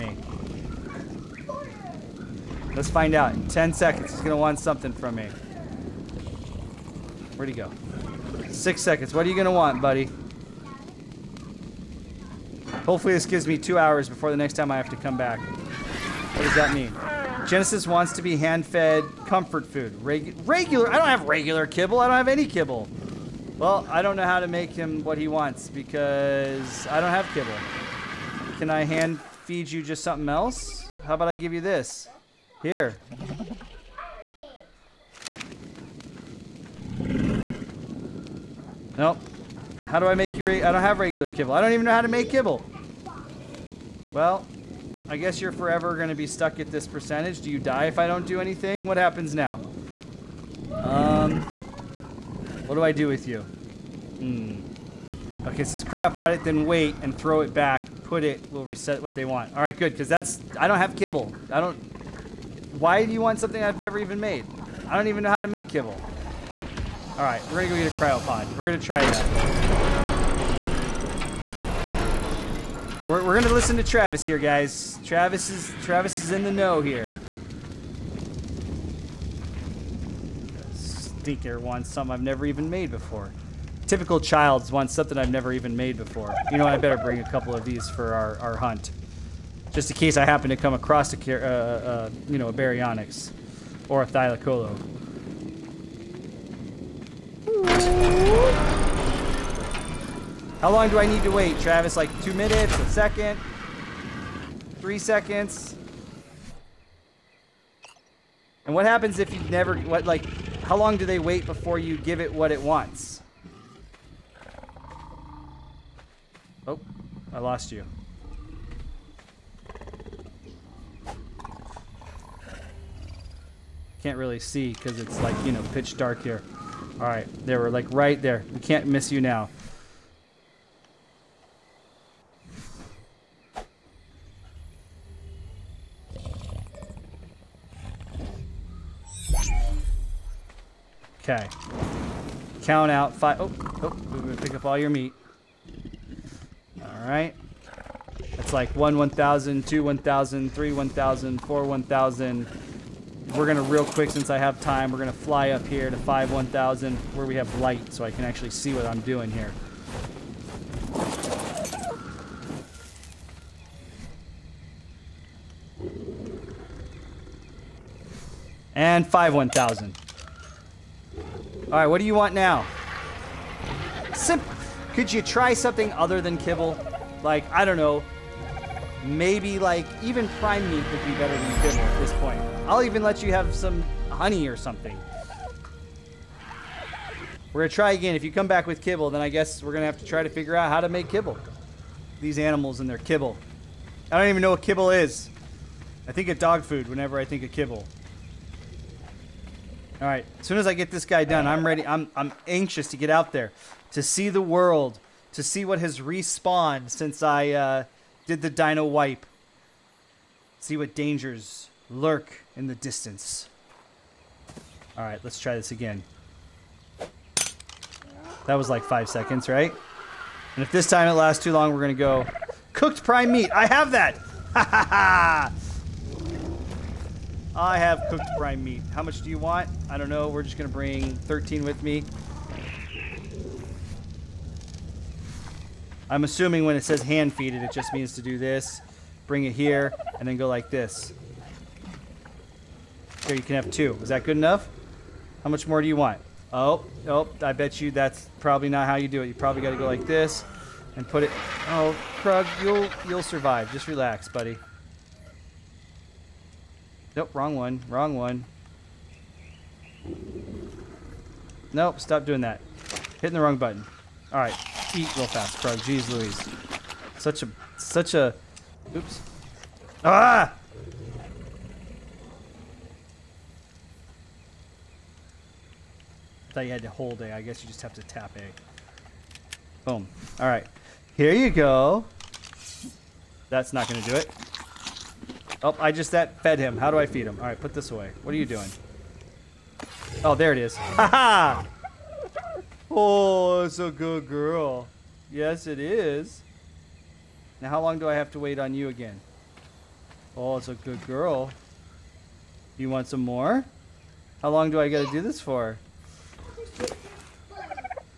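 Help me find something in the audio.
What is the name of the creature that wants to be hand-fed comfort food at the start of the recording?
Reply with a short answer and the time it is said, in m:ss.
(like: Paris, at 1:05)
Genesis, at 0:17.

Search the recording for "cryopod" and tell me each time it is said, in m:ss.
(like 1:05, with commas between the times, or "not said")
0:55, 1:07.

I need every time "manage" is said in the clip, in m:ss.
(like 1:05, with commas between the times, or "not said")
not said.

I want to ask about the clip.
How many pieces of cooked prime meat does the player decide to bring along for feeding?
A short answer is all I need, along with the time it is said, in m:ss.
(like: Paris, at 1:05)
13, at 3:51.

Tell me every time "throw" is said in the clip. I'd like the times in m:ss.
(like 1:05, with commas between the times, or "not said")
0:57.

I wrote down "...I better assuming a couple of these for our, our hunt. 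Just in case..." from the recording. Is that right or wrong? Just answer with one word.
wrong.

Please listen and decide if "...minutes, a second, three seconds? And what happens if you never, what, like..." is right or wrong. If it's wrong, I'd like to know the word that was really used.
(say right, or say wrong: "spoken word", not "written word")
right.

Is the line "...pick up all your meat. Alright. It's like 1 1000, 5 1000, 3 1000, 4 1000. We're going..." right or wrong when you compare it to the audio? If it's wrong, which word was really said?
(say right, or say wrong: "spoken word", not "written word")
wrong: "2", not "5".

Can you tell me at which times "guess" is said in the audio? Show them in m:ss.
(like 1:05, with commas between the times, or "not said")
0:45, 3:09, 4:37.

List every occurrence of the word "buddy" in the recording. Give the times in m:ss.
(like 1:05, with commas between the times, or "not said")
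0:09, 4:14.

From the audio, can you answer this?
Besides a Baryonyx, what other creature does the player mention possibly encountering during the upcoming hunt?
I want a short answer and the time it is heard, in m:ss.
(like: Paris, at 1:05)
Thylacoleo, at 1:34.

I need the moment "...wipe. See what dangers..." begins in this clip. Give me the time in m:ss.
3:28.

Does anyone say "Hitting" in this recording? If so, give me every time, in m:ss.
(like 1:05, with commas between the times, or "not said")
4:23.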